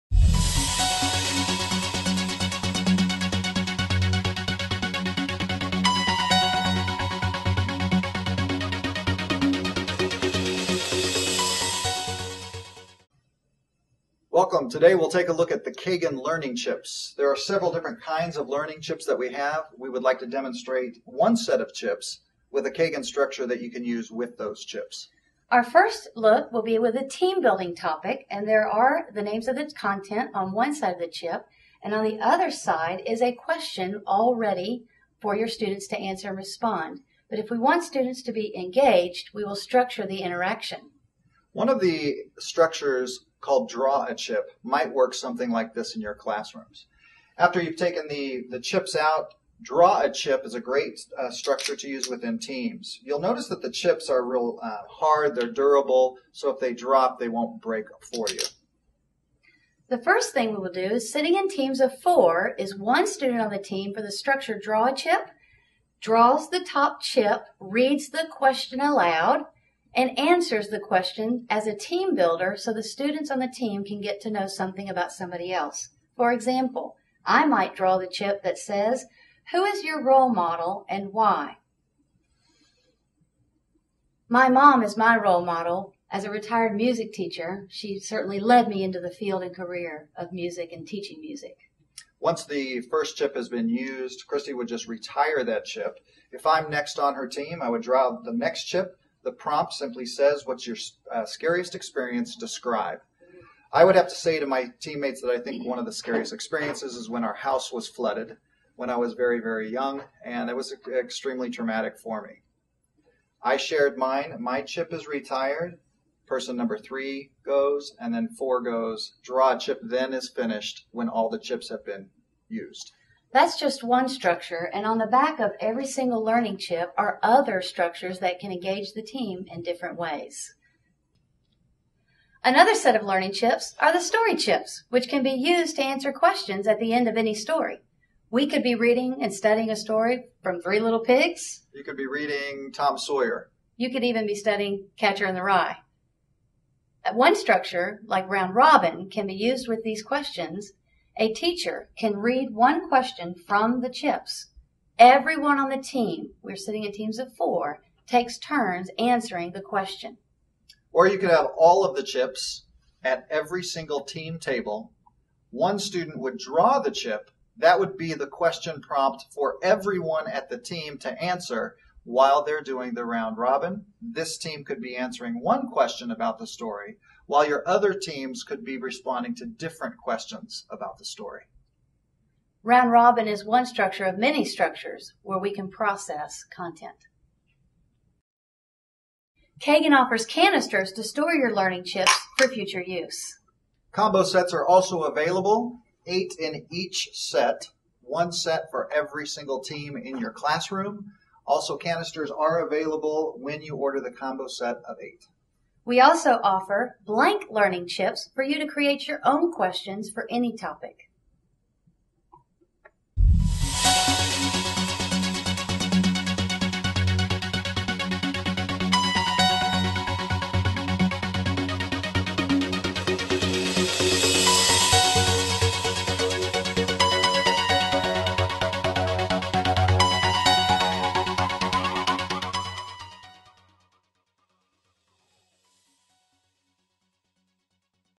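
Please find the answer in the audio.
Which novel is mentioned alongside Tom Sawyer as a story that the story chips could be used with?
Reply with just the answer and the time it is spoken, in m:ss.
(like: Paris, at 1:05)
Catcher in the Rye, at 2:24.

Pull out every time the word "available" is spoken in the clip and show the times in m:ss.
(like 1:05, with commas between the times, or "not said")
3:15, 3:22.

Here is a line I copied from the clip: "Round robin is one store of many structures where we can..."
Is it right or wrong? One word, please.
wrong.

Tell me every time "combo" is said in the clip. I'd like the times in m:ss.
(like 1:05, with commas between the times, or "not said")
3:13, 3:24.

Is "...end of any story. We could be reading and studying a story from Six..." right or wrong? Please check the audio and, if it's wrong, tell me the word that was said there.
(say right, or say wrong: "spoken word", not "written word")
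wrong: "Three", not "Six".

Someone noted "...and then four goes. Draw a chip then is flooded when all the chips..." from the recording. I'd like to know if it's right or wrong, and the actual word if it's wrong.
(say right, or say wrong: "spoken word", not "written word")
wrong: "finished", not "flooded".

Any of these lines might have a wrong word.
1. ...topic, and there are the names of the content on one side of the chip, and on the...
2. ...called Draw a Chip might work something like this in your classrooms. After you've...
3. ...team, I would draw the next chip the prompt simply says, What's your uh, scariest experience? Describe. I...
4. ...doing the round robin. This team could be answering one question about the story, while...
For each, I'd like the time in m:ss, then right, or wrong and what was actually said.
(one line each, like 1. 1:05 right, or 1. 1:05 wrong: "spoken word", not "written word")
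1. 0:27 right
2. 0:43 right
3. 1:37 right
4. 2:52 right.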